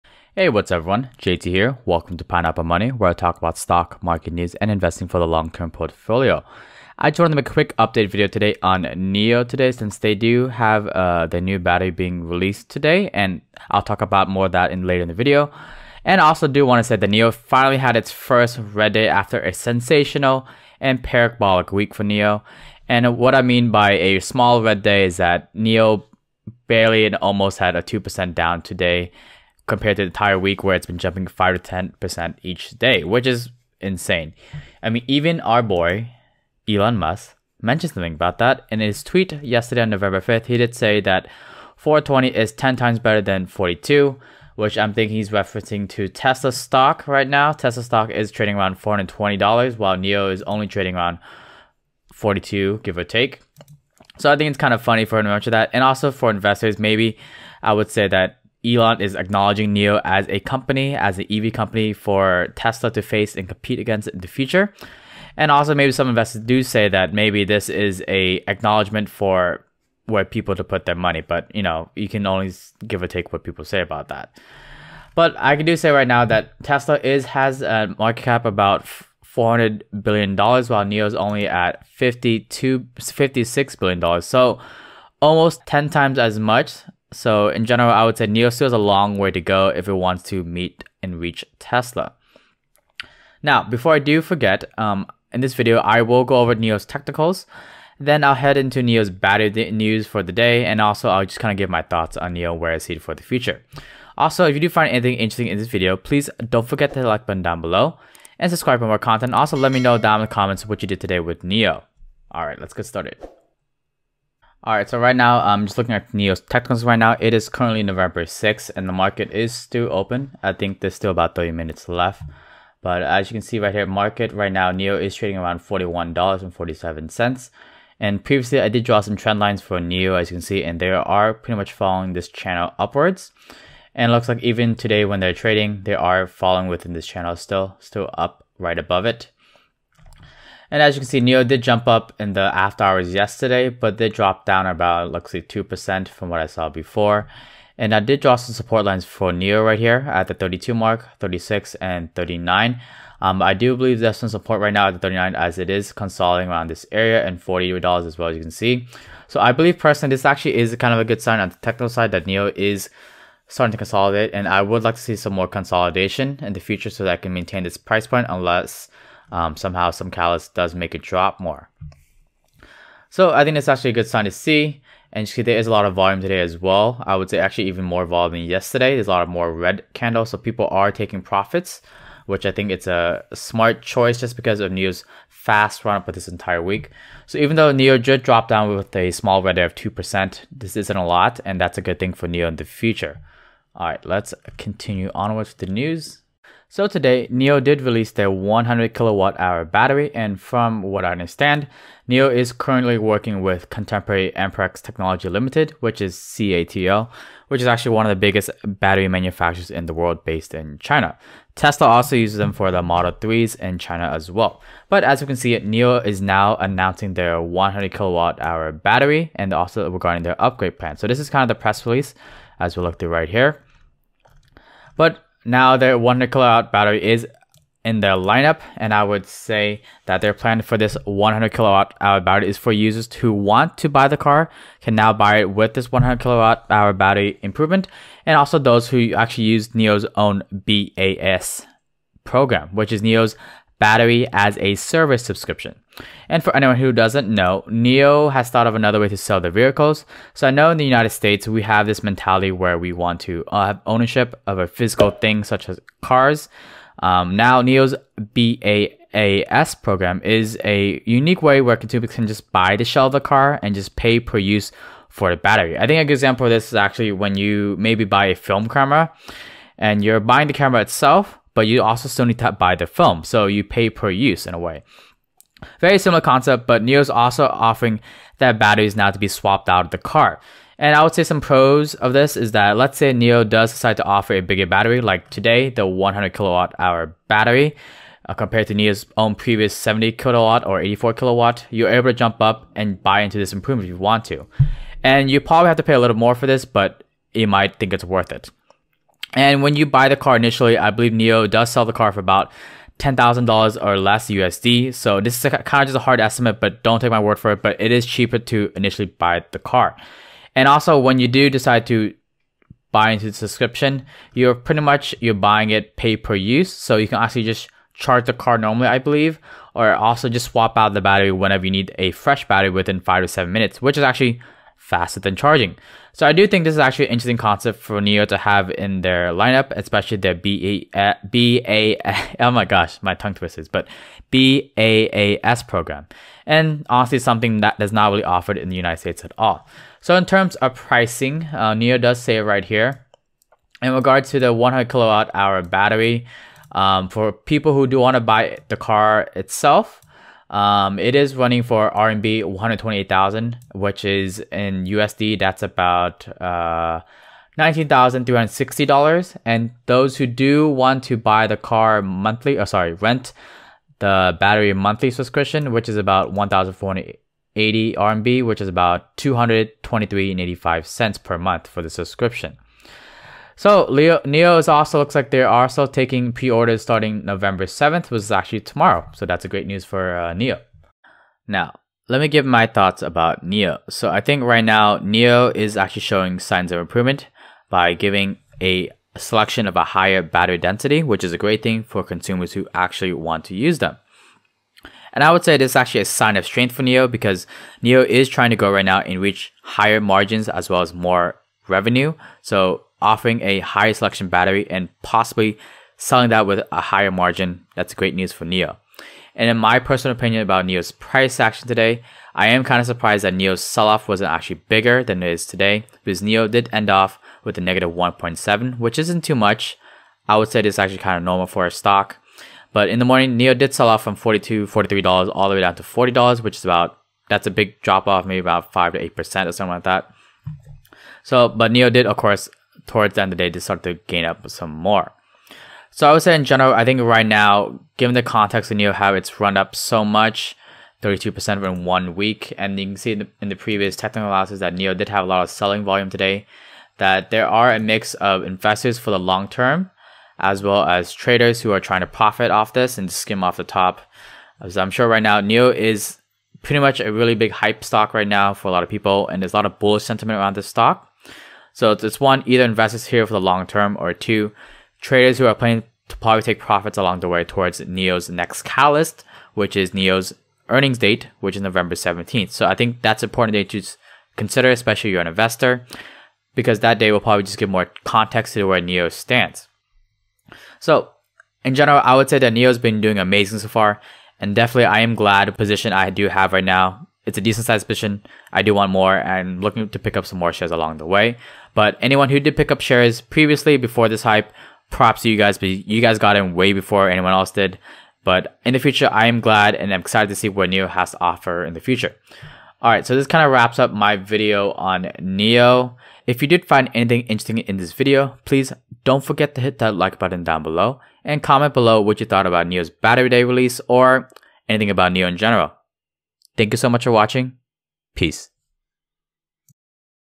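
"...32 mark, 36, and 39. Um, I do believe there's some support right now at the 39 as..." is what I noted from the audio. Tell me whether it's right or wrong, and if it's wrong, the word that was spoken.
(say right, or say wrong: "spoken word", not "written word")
right.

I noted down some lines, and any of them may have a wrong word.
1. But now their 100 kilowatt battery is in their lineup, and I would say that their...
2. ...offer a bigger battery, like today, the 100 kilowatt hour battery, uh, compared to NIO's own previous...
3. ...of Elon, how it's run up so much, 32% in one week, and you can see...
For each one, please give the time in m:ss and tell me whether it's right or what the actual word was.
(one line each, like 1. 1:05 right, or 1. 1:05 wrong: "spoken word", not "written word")
1. 3:44 right
2. 4:44 right
3. 7:18 wrong: "NIO", not "Elon".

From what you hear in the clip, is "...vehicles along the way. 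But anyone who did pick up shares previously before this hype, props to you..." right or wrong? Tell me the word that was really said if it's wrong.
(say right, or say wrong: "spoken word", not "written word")
wrong: "shares", not "vehicles".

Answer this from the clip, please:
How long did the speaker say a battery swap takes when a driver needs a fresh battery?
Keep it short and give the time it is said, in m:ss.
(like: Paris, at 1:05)
5 to 7 minutes, at 5:22.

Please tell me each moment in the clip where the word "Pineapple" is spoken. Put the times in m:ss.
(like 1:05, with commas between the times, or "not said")
0:02.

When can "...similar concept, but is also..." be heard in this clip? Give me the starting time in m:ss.
4:35.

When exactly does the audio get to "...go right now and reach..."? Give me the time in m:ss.
6:38.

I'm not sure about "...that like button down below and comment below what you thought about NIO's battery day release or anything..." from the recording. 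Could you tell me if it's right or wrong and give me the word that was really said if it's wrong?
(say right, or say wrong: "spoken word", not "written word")
right.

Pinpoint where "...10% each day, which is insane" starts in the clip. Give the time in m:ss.
0:31.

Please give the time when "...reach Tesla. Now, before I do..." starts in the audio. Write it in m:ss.
1:31.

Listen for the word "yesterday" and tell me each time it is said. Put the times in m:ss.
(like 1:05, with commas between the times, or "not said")
0:39, 2:23, 2:58.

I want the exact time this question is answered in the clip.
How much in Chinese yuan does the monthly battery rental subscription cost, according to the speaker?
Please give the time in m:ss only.
6:06.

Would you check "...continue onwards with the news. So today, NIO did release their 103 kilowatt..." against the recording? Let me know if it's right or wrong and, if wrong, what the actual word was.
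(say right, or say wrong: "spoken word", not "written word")
wrong: "100", not "103".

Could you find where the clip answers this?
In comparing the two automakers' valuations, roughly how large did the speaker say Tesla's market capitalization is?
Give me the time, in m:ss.
1:19.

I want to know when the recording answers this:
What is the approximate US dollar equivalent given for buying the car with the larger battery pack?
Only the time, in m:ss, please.
5:57.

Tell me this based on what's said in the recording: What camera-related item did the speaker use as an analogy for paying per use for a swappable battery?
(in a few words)
film camera.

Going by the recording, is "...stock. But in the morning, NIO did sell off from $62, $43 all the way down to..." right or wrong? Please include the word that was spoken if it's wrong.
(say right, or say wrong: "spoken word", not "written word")
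wrong: "42", not "62".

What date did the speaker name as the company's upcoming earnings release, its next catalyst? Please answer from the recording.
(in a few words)
November 17.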